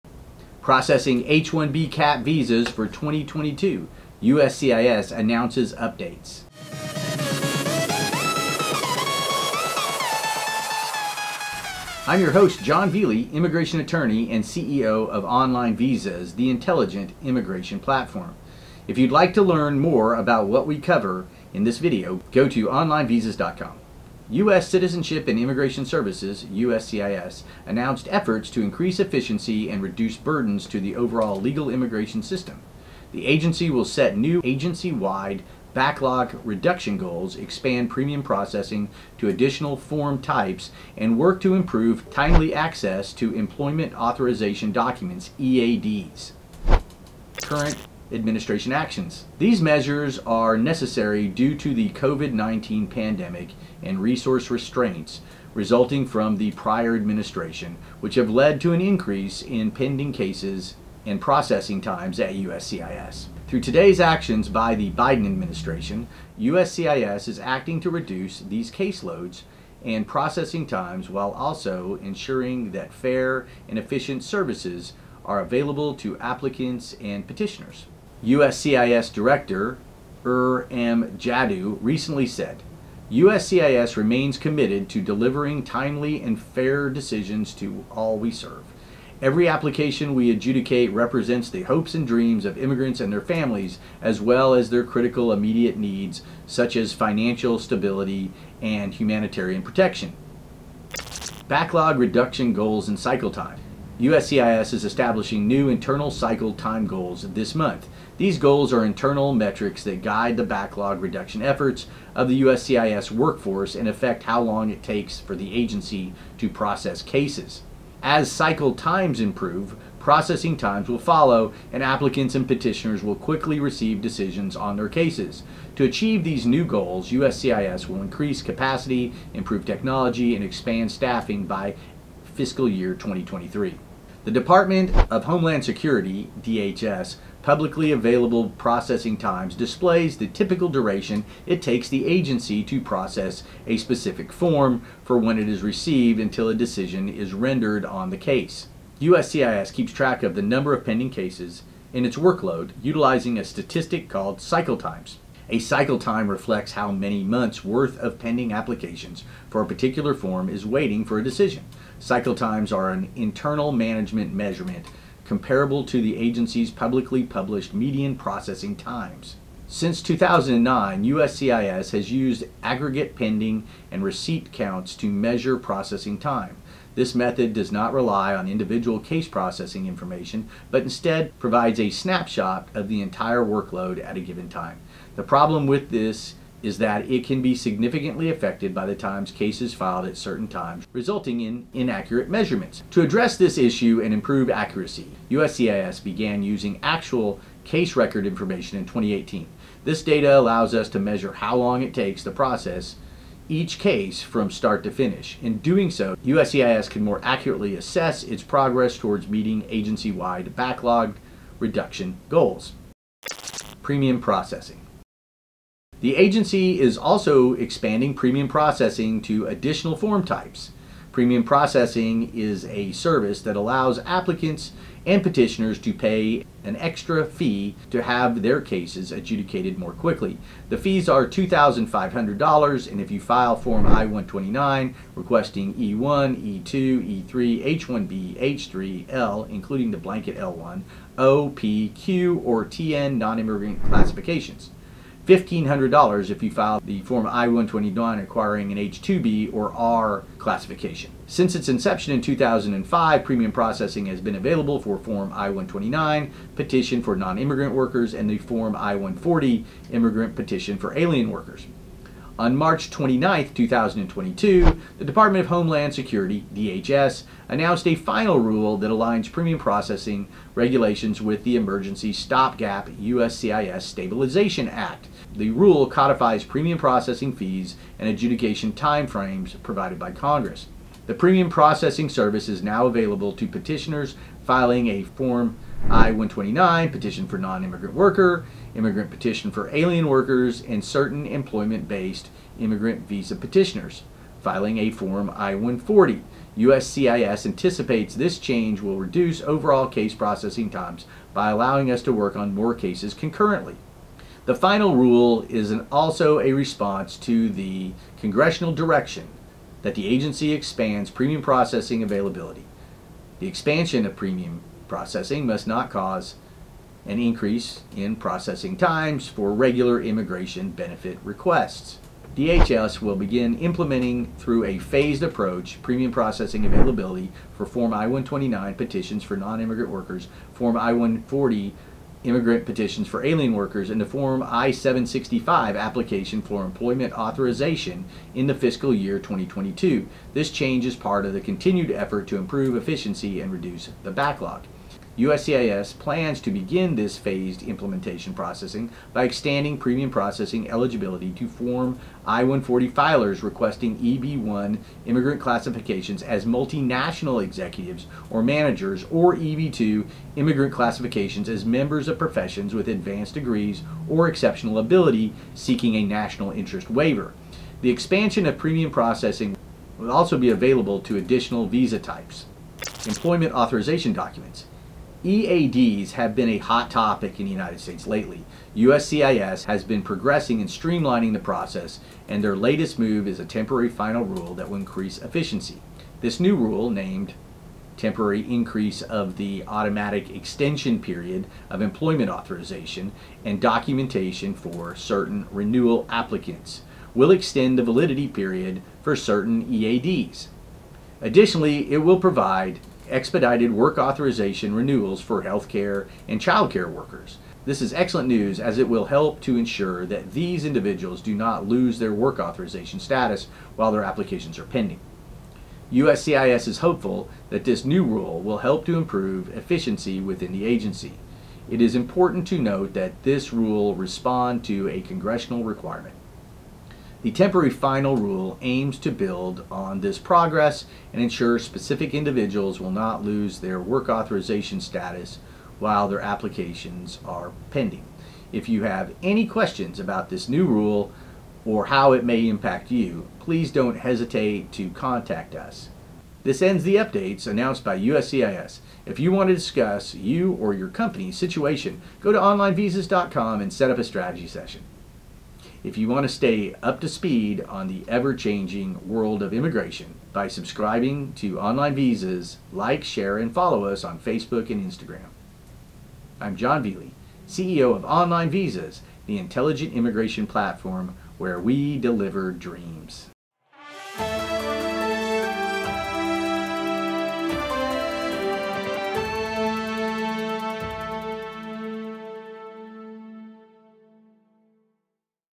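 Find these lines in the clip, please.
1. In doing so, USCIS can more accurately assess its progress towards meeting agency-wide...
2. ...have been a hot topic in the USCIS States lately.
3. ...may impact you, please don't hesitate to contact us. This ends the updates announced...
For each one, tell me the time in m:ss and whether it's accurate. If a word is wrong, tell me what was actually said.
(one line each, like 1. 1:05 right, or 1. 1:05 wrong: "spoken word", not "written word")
1. 3:25 right
2. 6:16 wrong: "United", not "USCIS"
3. 7:22 right.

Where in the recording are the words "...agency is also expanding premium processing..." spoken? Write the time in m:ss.
3:36.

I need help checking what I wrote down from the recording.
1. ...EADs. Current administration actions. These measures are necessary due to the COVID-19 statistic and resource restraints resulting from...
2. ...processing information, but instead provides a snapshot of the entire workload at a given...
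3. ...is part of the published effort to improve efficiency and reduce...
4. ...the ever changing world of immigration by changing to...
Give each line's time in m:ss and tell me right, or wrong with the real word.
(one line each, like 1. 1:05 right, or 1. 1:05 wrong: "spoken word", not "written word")
1. 0:45 wrong: "pandemic", not "statistic"
2. 2:59 right
3. 5:40 wrong: "continued", not "published"
4. 7:37 wrong: "subscribing", not "changing".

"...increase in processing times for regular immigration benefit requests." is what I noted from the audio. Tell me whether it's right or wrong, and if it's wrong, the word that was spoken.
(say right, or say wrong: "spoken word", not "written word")
right.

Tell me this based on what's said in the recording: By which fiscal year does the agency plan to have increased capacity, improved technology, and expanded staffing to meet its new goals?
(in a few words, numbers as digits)
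2023.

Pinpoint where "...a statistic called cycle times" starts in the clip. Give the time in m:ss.
2:33.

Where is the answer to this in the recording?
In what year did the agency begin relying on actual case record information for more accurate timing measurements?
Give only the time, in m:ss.
3:18.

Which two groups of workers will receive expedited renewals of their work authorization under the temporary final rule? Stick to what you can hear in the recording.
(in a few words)
healthcare and childcare.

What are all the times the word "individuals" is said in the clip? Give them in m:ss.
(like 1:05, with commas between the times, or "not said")
2:58, 6:50, 7:12.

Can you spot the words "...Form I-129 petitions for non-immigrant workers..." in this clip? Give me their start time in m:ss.
5:27.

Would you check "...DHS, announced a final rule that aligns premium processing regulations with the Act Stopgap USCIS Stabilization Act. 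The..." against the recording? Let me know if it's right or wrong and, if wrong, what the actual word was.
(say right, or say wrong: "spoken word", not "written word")
wrong: "Emergency", not "Act".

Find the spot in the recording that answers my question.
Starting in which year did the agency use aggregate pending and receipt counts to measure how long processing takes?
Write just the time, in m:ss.
2:49.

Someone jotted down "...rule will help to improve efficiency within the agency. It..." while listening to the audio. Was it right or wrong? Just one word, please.
right.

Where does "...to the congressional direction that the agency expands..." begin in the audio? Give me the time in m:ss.
5:07.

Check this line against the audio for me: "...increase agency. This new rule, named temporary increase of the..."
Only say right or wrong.
wrong.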